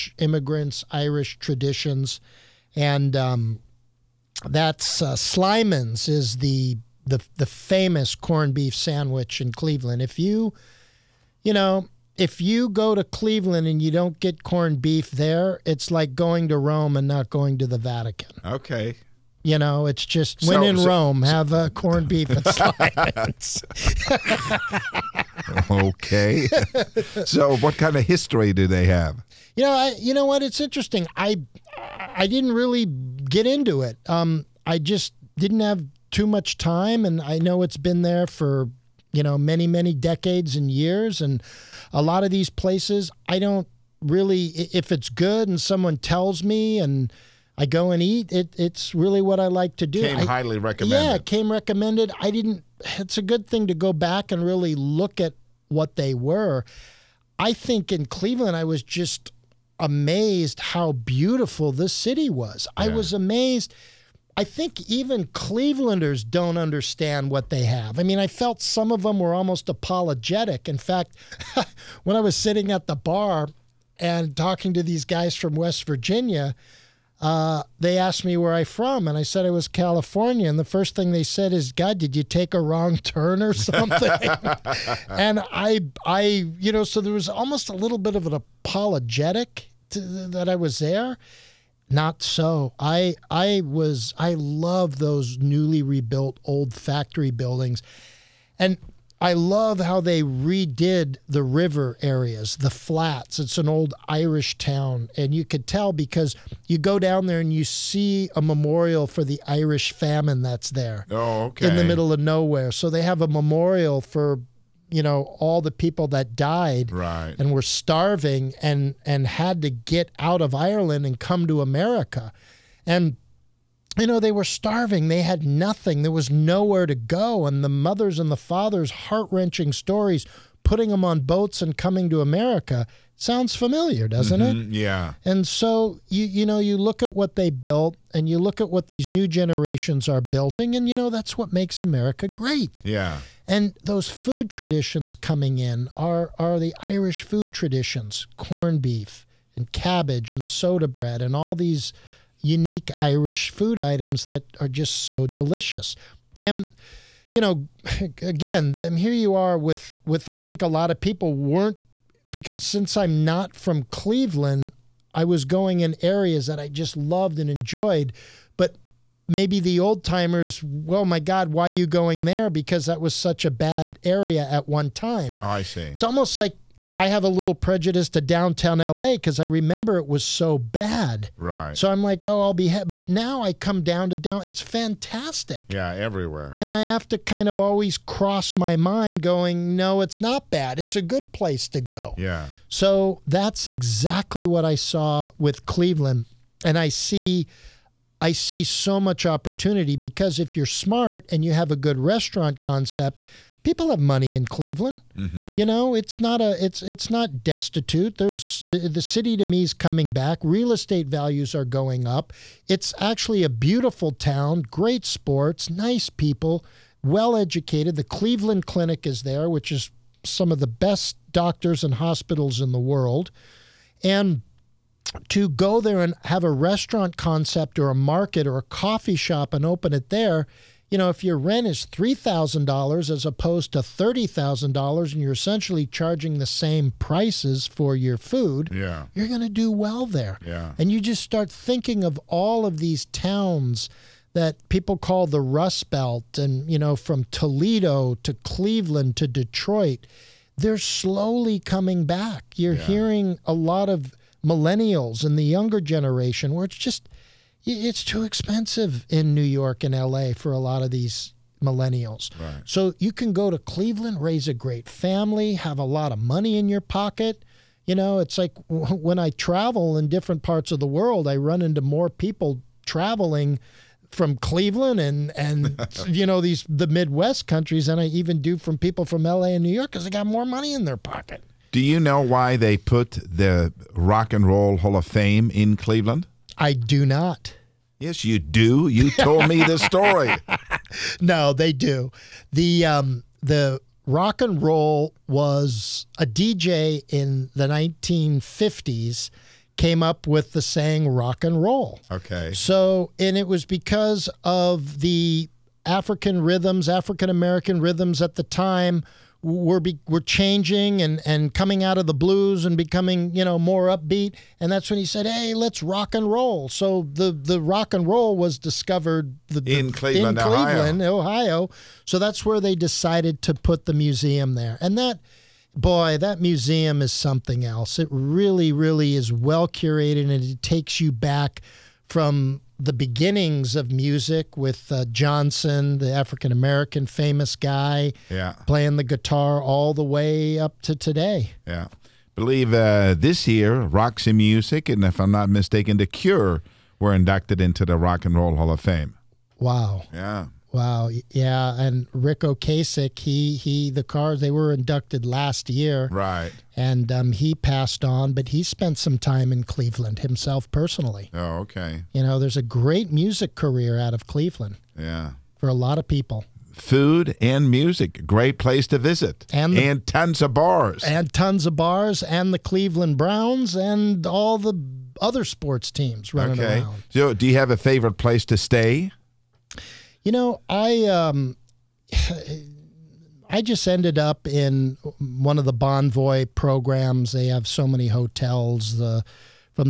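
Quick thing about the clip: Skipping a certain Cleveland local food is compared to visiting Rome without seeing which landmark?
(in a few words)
the Vatican.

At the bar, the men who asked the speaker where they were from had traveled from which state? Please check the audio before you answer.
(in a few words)
West Virginia.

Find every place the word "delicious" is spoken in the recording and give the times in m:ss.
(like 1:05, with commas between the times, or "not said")
2:35.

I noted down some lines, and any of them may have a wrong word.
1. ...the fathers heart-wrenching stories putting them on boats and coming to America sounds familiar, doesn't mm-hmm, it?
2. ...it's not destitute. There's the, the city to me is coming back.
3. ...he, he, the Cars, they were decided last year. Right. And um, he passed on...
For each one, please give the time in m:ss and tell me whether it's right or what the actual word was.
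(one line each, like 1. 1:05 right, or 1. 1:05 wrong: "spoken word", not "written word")
1. 2:08 right
2. 3:26 right
3. 5:53 wrong: "inducted", not "decided".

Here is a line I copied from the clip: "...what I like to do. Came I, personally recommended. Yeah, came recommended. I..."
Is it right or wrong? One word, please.
wrong.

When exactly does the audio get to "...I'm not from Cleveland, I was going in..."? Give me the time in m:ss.
2:42.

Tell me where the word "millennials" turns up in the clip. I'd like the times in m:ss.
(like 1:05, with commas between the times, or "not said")
4:14, 4:21.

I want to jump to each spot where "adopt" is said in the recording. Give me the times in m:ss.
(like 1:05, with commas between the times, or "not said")
not said.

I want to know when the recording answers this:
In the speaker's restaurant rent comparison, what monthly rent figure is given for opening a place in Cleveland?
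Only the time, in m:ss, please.
3:51.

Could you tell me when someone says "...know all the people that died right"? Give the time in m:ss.
1:55.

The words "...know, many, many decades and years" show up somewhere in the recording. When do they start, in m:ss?
0:39.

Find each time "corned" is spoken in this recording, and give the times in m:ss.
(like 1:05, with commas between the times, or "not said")
0:08, 0:14, 0:21, 2:28.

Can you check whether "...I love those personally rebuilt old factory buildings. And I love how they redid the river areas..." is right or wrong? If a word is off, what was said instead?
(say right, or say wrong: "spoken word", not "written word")
wrong: "newly", not "personally".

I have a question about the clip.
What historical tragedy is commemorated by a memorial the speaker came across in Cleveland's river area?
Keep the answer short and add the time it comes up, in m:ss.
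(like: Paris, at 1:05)
Irish famine, at 1:49.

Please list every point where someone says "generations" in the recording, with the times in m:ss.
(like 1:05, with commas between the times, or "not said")
2:19, 4:15.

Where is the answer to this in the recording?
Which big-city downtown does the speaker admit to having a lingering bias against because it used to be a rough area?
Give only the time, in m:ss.
2:58.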